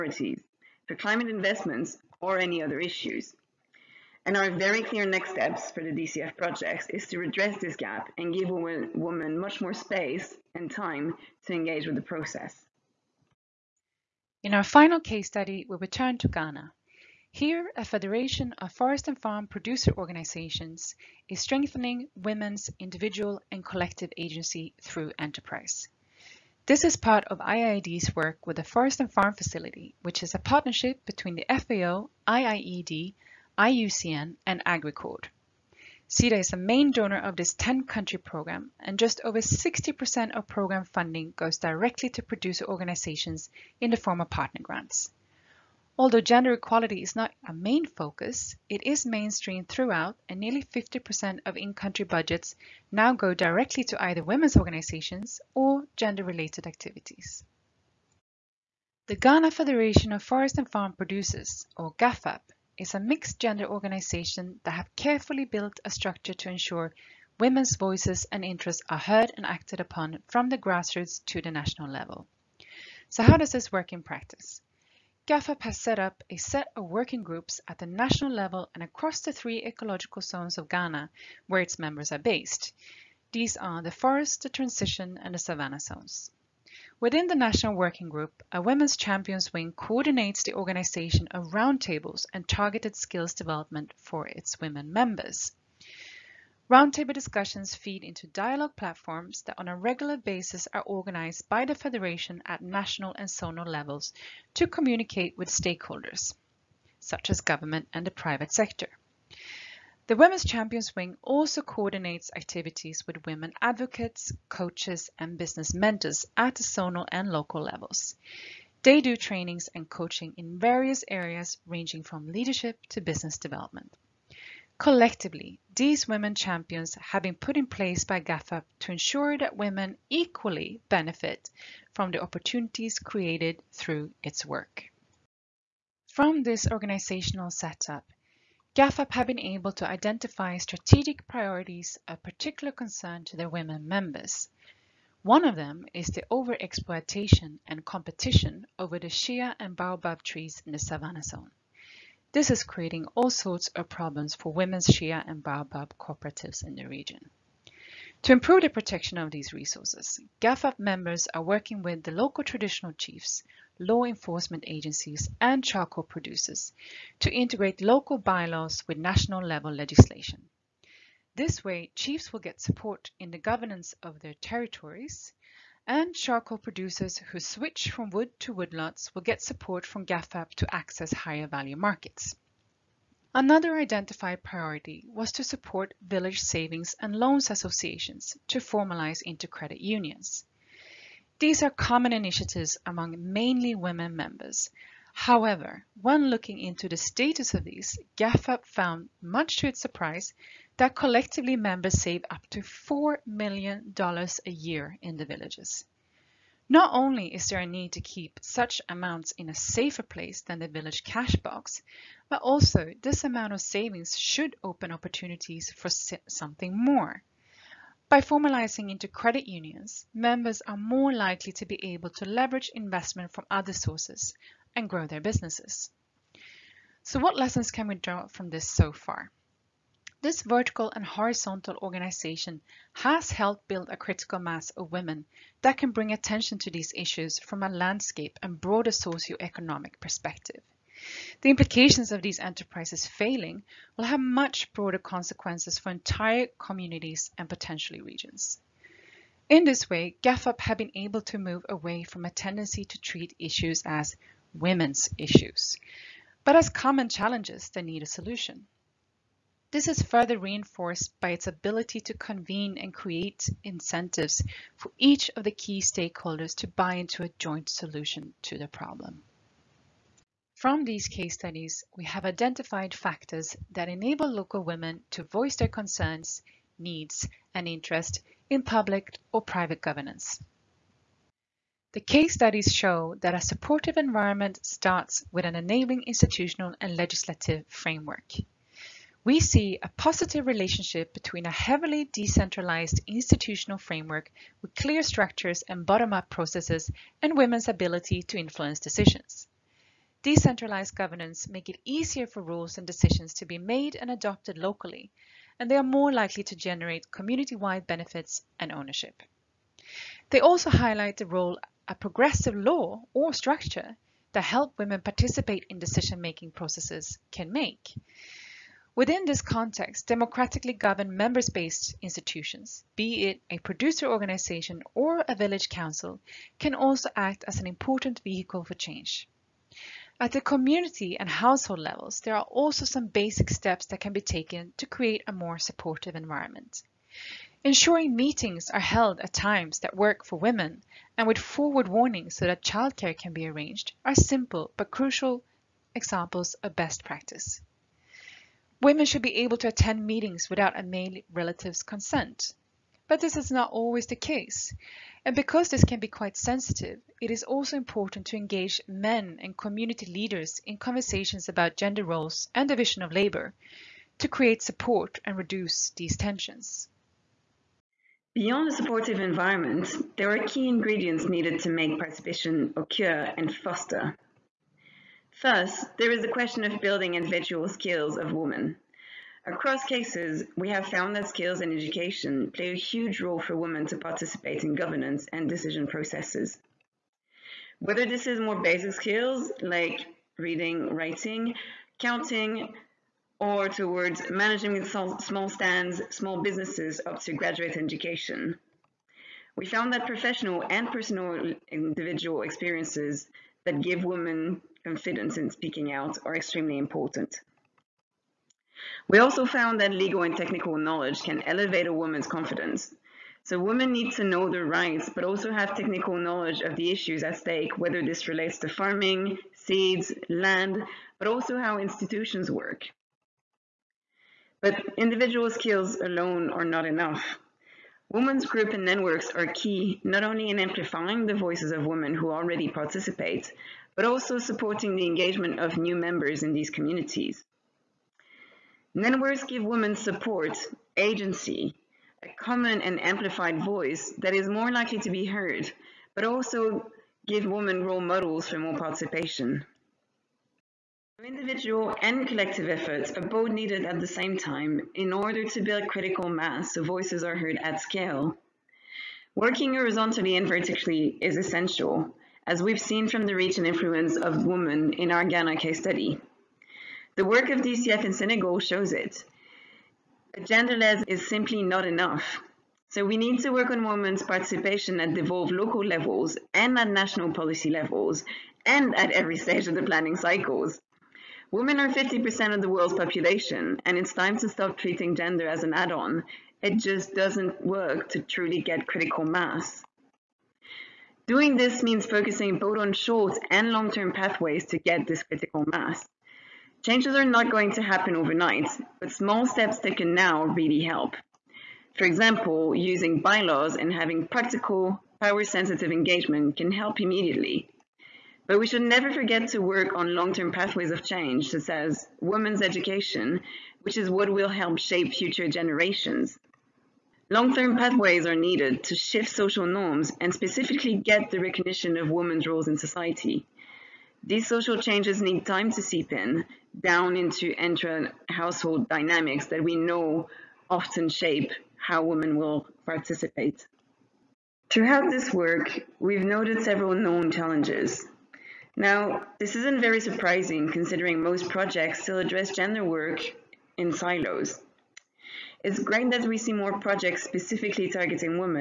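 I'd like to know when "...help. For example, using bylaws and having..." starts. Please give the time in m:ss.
8:20.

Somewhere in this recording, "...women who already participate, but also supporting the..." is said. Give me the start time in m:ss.
7:11.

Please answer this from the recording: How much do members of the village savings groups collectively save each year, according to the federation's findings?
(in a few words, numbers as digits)
$4 million.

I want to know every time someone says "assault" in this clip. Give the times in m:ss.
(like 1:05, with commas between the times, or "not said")
not said.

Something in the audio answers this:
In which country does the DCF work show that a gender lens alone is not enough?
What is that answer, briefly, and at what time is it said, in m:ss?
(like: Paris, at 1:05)
Senegal, at 7:48.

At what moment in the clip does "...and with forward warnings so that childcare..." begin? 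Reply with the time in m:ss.
5:41.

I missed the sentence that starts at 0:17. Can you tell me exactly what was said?
Here, a federation of forest and farm producer organizations is strengthening women's individual and collective agency through enterprise.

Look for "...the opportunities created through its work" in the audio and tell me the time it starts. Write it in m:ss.
2:12.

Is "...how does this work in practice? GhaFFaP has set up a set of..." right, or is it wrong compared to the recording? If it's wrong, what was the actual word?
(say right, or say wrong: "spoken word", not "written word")
right.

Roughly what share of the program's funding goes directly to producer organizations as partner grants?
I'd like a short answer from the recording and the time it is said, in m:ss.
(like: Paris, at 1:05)
just over 60%, at 0:38.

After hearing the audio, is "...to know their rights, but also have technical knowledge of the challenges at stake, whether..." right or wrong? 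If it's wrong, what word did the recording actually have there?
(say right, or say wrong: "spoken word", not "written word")
wrong: "issues", not "challenges".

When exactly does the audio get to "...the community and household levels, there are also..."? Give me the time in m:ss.
5:30.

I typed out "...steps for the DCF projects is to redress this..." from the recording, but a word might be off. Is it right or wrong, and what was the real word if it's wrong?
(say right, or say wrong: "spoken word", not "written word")
right.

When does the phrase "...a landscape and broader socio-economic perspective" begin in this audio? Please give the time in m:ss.
3:57.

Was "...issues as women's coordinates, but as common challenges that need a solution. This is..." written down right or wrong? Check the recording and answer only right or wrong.
wrong.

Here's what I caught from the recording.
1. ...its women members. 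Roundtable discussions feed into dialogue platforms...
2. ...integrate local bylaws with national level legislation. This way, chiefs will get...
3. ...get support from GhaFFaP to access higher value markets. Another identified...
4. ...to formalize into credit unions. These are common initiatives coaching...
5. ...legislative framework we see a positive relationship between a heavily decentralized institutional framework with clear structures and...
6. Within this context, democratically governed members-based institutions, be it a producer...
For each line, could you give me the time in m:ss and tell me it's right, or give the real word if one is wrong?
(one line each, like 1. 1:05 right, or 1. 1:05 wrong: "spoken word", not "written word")
1. 1:34 right
2. 2:47 right
3. 2:59 right
4. 3:08 wrong: "among", not "coaching"
5. 4:46 right
6. 5:18 right.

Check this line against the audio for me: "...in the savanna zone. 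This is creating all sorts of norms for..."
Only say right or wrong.
wrong.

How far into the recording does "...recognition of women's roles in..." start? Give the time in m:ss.
8:41.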